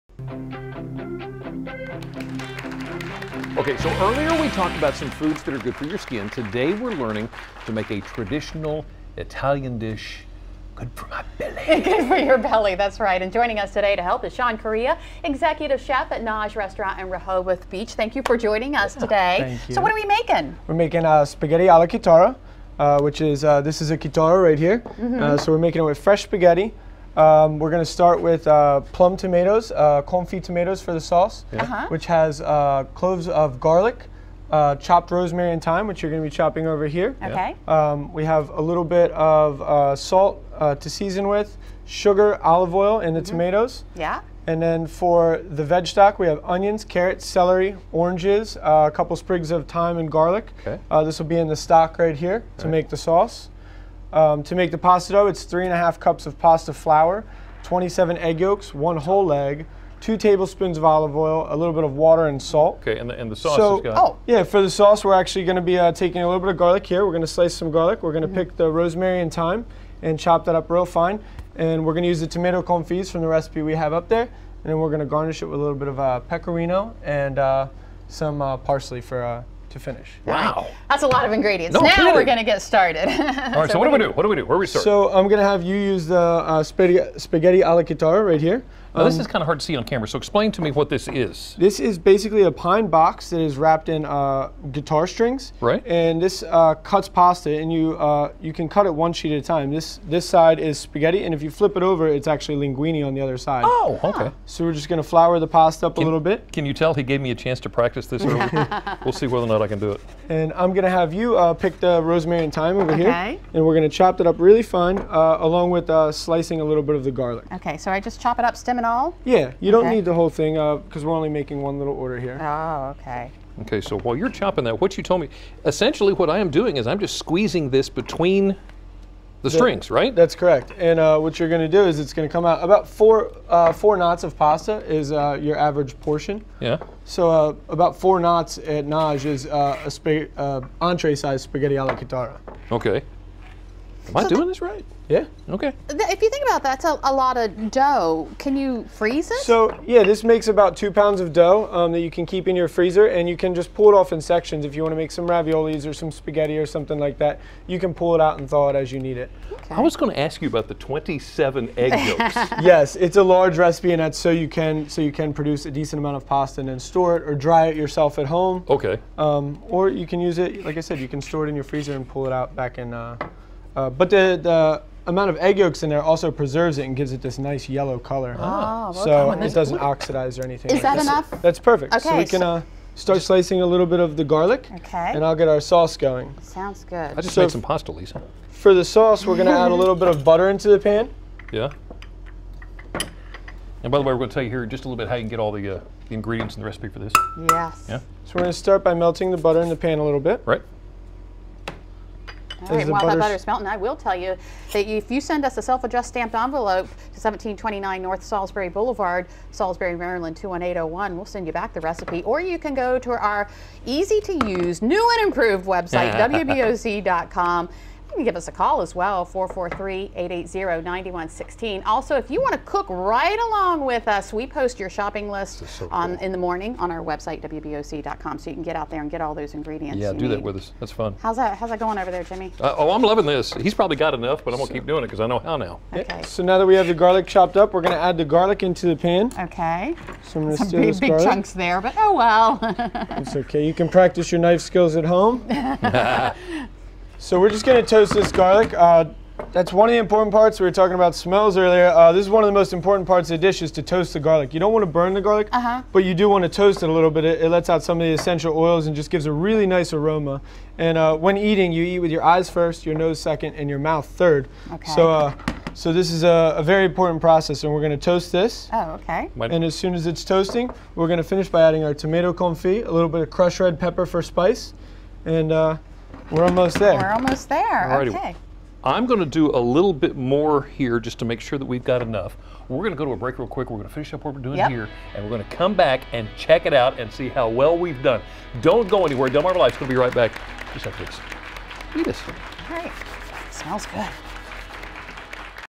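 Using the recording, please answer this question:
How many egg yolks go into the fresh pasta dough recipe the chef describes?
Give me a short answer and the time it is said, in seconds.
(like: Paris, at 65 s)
27, at 57 s.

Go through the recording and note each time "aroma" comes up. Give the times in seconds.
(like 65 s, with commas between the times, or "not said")
259 s.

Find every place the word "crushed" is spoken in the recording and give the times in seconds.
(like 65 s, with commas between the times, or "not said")
273 s.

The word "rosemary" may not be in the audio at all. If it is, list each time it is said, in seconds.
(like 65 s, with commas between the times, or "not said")
35 s, 68 s, 112 s.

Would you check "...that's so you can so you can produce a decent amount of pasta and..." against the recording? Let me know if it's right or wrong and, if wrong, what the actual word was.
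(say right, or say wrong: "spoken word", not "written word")
right.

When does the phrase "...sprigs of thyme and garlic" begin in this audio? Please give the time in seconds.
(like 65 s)
49 s.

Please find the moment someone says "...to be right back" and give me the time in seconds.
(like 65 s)
289 s.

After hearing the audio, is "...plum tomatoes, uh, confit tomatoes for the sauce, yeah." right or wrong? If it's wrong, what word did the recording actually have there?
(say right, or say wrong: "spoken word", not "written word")
right.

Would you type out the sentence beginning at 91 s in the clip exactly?
This is basically a pine box that is wrapped in uh, guitar strings.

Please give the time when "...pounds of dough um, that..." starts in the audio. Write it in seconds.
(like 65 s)
150 s.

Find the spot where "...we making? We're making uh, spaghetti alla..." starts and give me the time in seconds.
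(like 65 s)
19 s.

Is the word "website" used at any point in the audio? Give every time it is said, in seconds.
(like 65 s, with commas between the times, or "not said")
215 s, 227 s.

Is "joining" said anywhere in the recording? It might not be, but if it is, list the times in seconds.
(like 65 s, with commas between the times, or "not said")
13 s, 18 s.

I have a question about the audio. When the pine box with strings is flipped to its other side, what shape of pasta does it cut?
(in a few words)
linguine.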